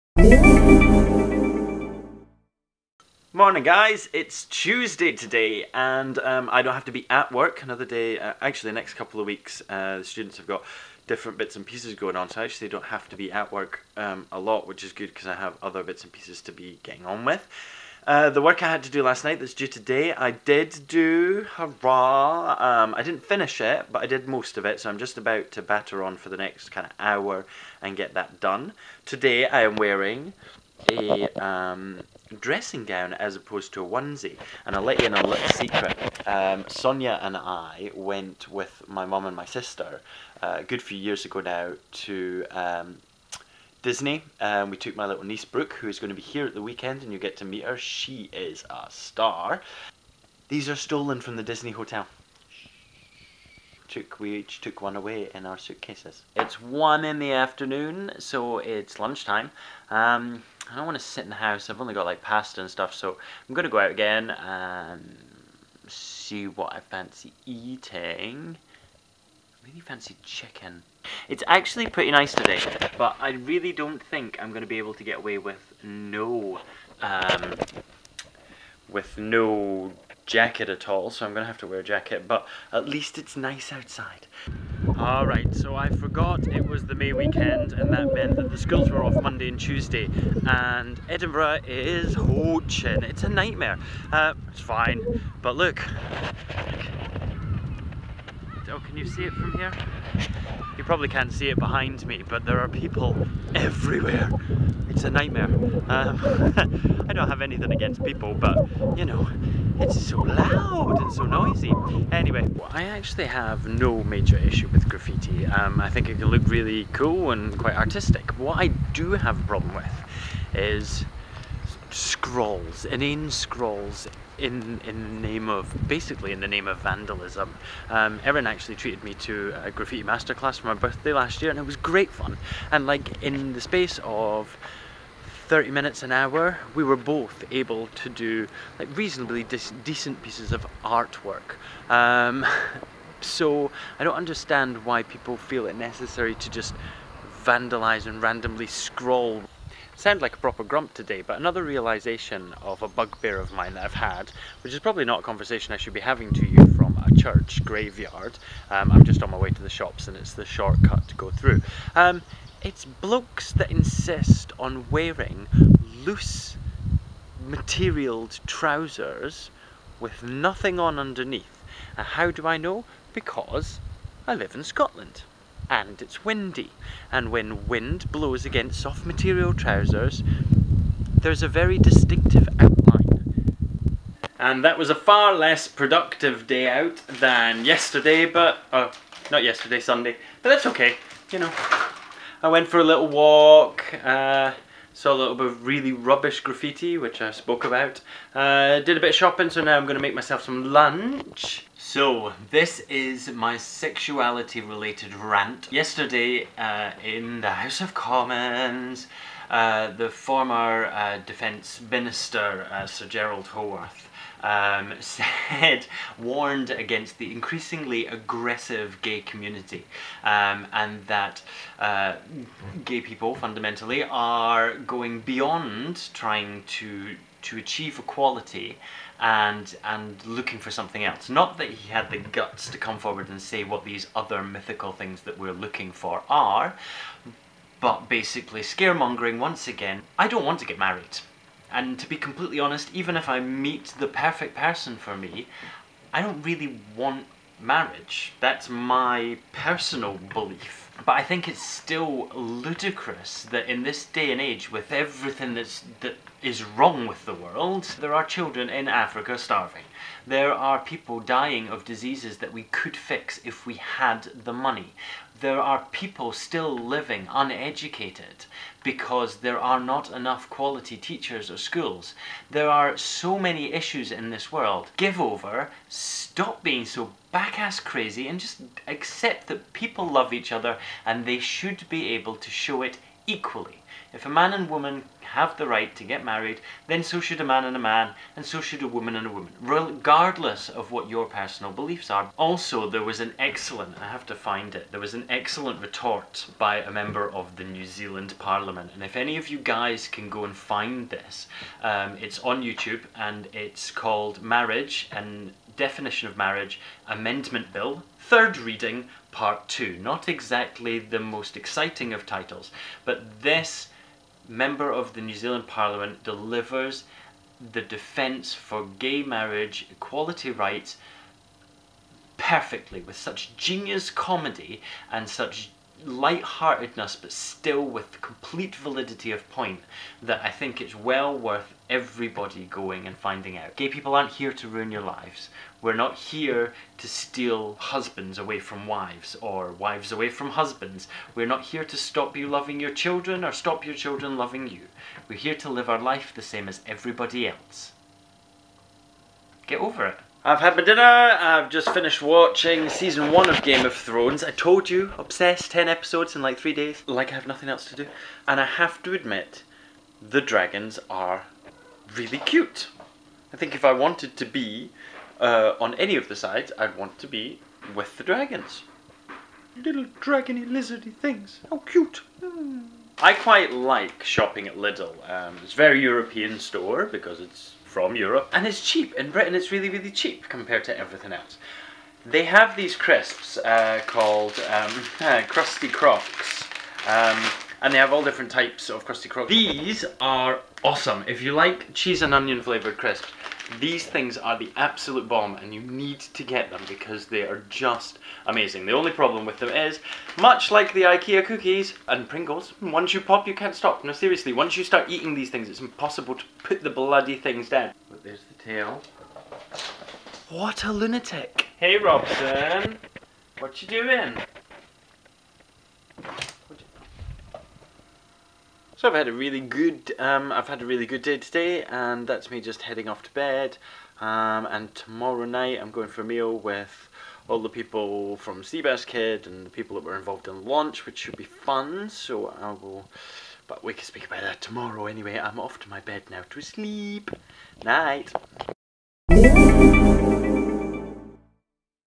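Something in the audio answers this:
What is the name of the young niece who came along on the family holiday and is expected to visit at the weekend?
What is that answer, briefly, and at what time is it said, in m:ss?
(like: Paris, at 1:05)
Brooke, at 0:45.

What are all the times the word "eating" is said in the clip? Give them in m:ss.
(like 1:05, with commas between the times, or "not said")
1:07, 6:45.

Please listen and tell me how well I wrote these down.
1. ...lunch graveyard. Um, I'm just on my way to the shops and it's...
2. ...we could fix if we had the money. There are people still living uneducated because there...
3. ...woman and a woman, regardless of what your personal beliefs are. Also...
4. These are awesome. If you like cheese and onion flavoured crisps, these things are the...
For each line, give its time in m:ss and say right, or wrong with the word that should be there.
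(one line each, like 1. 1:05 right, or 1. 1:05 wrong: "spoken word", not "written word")
1. 2:37 wrong: "church", not "lunch"
2. 4:22 right
3. 4:48 right
4. 6:29 right.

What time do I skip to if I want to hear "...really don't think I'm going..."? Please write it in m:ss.
1:13.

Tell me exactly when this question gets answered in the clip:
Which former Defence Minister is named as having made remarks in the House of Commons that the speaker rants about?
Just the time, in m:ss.
3:32.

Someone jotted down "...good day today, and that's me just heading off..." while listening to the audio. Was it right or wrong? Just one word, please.
right.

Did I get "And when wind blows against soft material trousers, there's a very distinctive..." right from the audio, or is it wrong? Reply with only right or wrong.
right.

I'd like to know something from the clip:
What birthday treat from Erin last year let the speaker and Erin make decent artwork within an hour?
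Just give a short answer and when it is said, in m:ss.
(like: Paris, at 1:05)
Graffiti masterclass, at 2:09.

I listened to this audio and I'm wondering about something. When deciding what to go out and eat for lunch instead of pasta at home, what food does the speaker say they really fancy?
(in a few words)
Chicken.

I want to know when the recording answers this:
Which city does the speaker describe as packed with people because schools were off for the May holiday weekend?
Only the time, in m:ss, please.
1:31.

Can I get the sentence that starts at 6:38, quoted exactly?
The only problem with them is, much like the IKEA cookies and Pringles, once you pop you can't stop.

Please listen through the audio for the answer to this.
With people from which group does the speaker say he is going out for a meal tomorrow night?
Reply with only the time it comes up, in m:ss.
7:08.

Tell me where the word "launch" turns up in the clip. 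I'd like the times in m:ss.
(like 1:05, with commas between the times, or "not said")
7:10.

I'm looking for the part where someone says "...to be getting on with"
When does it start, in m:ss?
0:16.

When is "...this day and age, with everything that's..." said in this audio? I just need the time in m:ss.
4:13.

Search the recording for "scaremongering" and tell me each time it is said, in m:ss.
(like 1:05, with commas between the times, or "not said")
3:58.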